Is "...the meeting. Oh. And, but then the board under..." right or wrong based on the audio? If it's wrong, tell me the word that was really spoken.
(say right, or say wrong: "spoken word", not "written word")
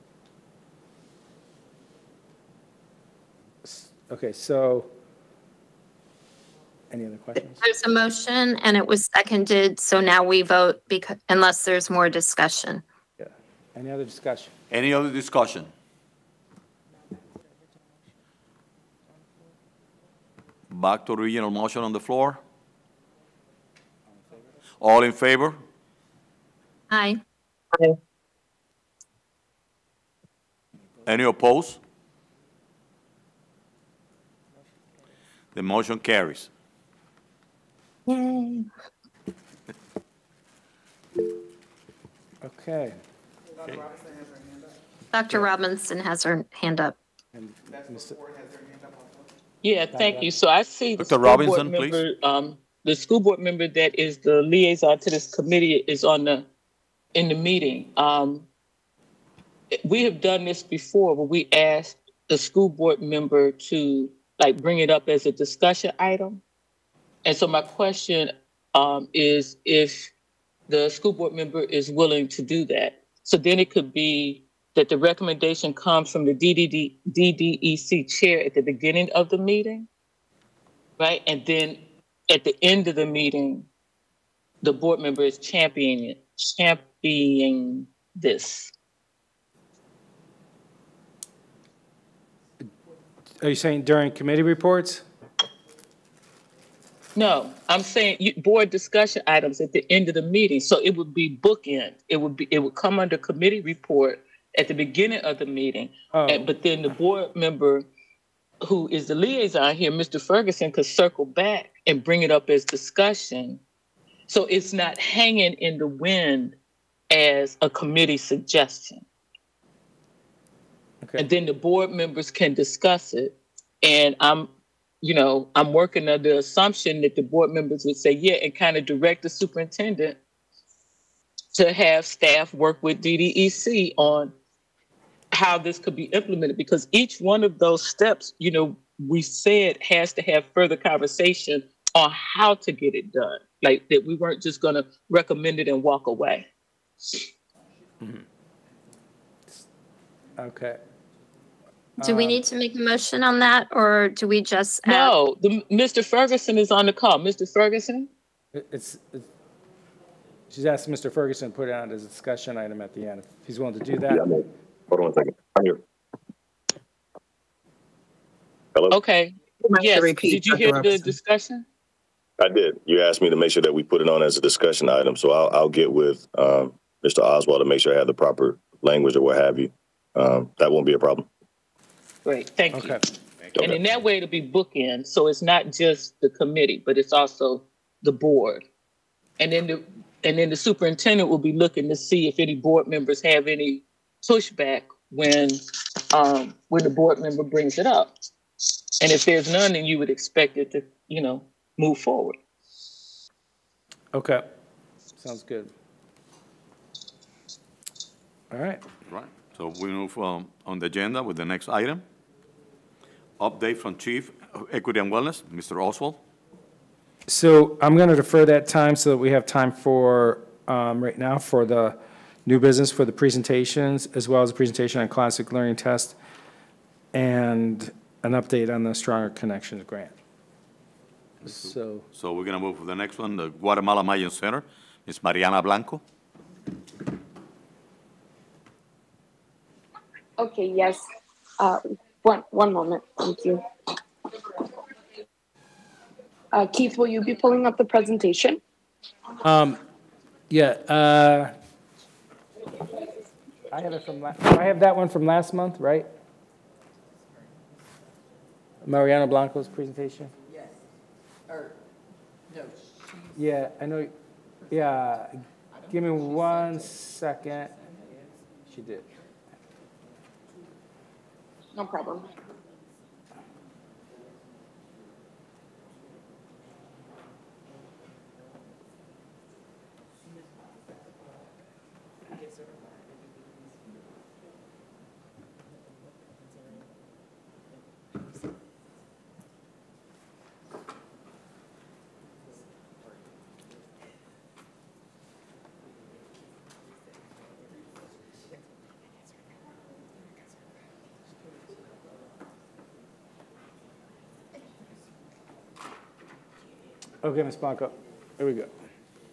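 wrong: "member", not "under".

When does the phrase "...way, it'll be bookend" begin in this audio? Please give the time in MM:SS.
03:04.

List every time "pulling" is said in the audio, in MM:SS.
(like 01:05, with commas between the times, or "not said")
04:07.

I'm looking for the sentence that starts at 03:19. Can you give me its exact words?
And if there's none, then you would expect it to, you know, move forward.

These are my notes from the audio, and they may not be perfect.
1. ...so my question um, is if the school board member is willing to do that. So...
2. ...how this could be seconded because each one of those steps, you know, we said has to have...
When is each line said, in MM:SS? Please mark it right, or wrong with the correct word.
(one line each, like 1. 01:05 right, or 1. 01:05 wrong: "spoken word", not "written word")
1. 01:07 right
2. 02:15 wrong: "implemented", not "seconded".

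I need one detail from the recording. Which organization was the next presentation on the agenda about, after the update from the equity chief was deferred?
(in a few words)
Guatemala Mayan Center.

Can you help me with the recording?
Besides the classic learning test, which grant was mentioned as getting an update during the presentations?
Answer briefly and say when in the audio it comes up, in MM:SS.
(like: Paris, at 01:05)
Stronger Connections, at 03:48.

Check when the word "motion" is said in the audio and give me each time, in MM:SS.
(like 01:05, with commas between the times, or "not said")
00:07, 00:21, 00:35, 02:32.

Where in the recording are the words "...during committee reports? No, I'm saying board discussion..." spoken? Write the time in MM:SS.
01:33.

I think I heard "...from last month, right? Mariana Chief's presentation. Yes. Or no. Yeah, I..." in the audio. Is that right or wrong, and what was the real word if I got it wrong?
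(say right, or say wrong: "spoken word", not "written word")
wrong: "Blanco", not "Chief".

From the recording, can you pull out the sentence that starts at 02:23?
Like that we weren't just going to recommend it and walk away.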